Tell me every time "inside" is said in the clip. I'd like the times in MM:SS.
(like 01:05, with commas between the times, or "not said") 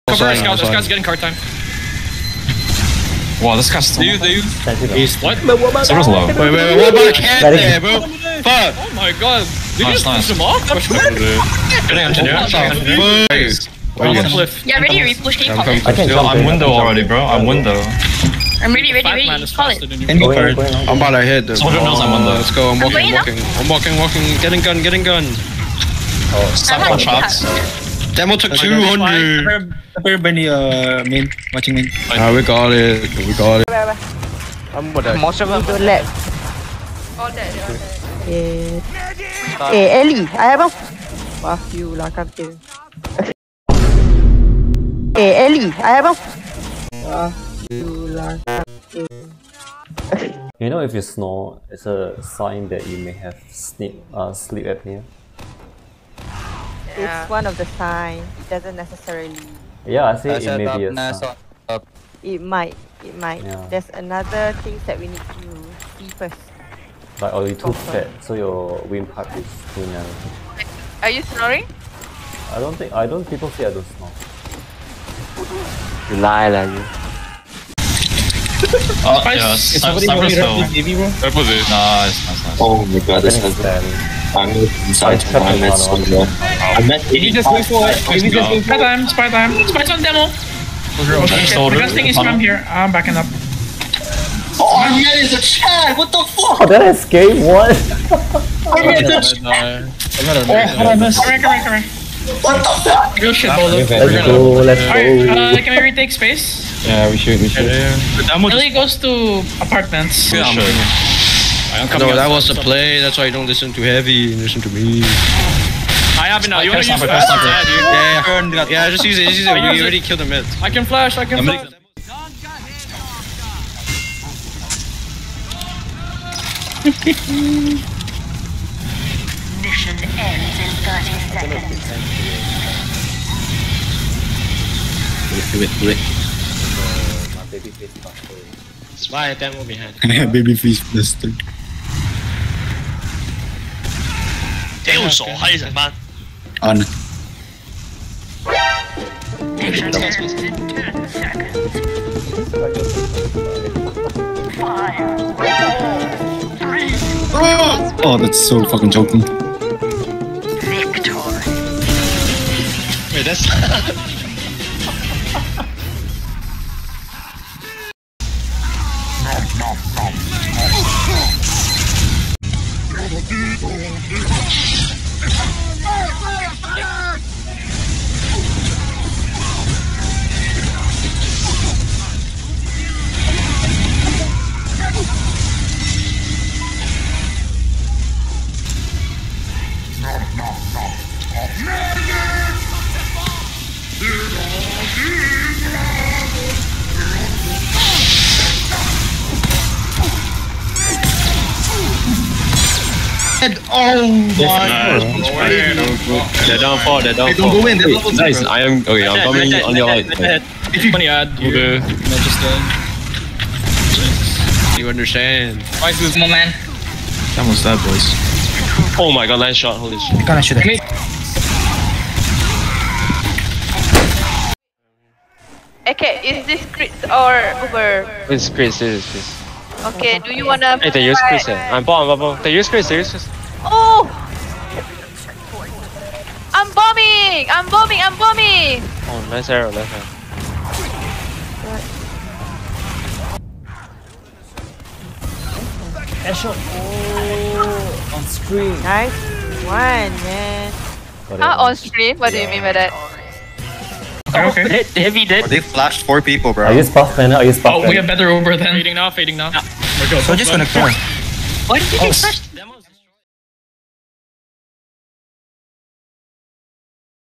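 01:24.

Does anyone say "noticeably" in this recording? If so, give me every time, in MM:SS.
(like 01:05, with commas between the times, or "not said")
not said.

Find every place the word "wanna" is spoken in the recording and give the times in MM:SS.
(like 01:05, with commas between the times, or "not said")
01:56, 03:50.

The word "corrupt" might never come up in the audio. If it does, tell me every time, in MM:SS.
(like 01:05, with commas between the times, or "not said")
not said.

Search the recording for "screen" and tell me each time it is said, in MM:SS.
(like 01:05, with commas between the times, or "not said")
04:08.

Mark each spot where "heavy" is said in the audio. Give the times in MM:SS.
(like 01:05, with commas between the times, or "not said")
01:53.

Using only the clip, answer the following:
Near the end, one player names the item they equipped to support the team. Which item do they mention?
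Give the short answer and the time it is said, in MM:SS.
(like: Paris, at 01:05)
Buff Banner, at 04:16.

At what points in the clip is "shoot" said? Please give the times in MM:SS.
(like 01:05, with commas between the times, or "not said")
03:40.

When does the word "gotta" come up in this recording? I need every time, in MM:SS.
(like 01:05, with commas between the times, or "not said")
03:40.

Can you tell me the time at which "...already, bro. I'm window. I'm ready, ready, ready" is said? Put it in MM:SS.
00:16.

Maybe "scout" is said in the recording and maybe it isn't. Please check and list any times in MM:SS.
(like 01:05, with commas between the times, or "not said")
00:00.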